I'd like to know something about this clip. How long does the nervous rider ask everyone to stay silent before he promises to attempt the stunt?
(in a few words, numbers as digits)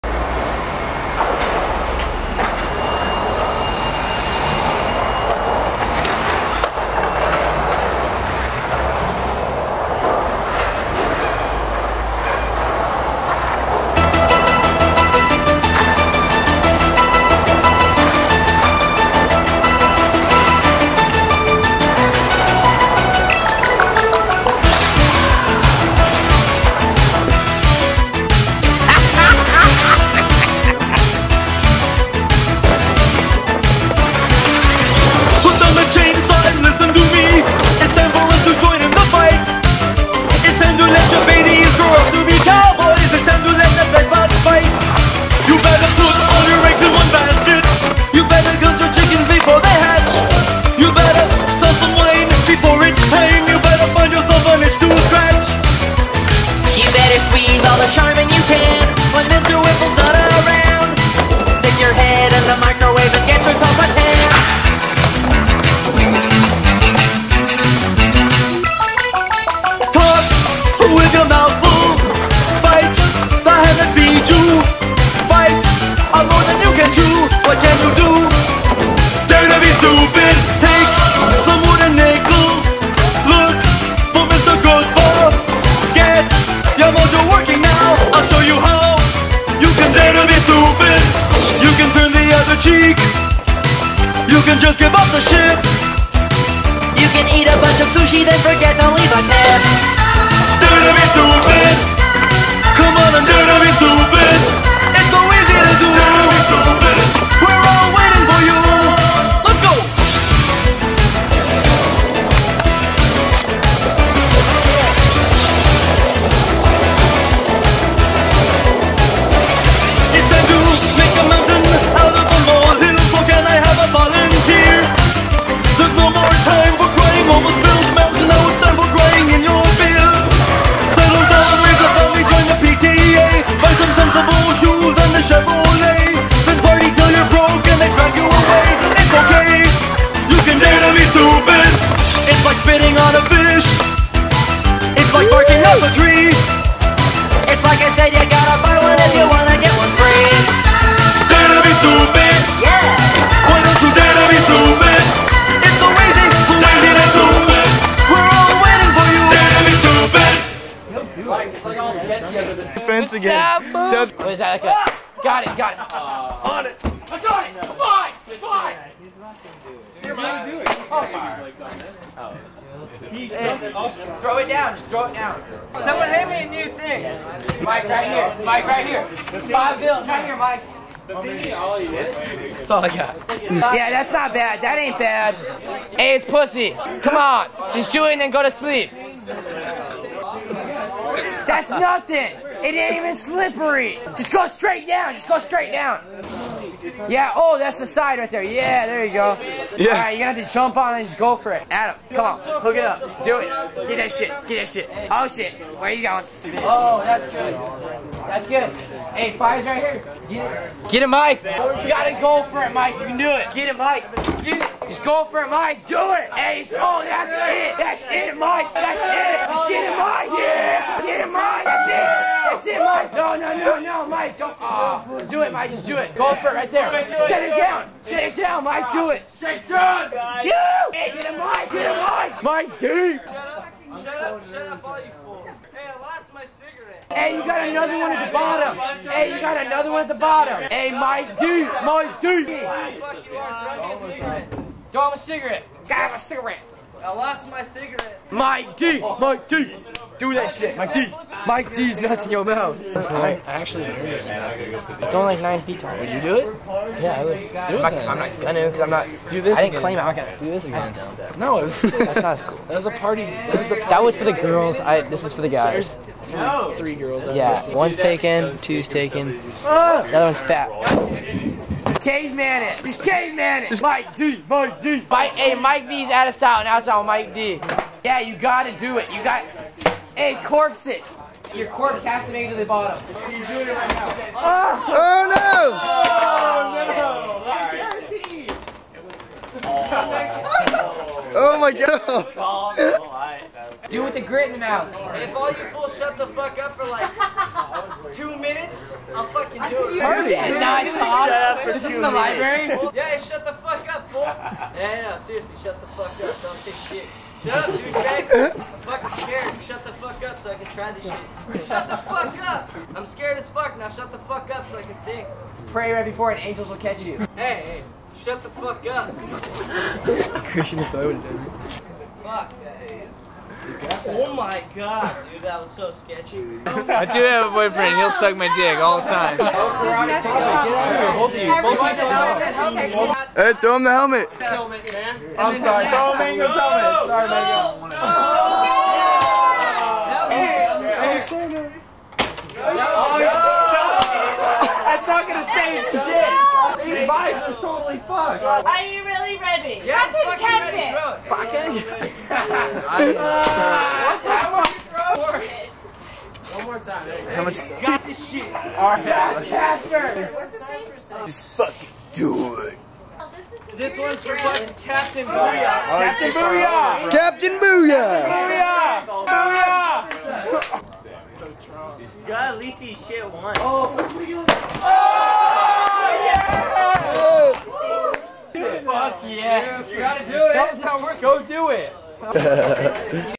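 2 minutes.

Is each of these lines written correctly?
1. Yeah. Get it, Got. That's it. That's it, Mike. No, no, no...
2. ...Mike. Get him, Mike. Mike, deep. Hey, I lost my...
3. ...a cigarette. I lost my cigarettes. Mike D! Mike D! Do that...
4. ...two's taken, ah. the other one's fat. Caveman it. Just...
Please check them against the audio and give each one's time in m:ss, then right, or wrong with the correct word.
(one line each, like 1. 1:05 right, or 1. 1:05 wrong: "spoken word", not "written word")
1. 3:40 wrong: "Mike", not "Got"
2. 3:51 right
3. 4:05 right
4. 4:28 right.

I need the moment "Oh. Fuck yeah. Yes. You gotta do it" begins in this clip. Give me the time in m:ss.
6:17.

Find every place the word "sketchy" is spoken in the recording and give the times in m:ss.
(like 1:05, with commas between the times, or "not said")
5:25.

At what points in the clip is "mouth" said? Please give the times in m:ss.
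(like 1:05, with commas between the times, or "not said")
4:12, 4:54.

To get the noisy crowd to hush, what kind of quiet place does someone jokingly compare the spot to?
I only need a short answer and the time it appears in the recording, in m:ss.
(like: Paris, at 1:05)
the library, at 5:01.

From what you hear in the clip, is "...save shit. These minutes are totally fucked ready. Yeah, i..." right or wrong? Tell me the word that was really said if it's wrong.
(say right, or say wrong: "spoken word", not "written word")
wrong: "vibes", not "minutes".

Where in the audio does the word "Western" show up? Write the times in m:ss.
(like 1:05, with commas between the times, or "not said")
not said.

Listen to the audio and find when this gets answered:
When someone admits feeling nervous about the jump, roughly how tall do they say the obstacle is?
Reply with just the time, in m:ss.
4:15.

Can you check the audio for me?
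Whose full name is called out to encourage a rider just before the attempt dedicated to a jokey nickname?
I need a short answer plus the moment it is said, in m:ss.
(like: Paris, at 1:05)
Josh Casper, at 5:59.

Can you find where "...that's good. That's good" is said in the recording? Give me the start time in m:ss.
3:27.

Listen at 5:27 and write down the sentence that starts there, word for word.
He'll suck my dick all the time.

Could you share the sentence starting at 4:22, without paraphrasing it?
That was a party, that was, party.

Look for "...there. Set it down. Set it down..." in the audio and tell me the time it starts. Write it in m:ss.
3:46.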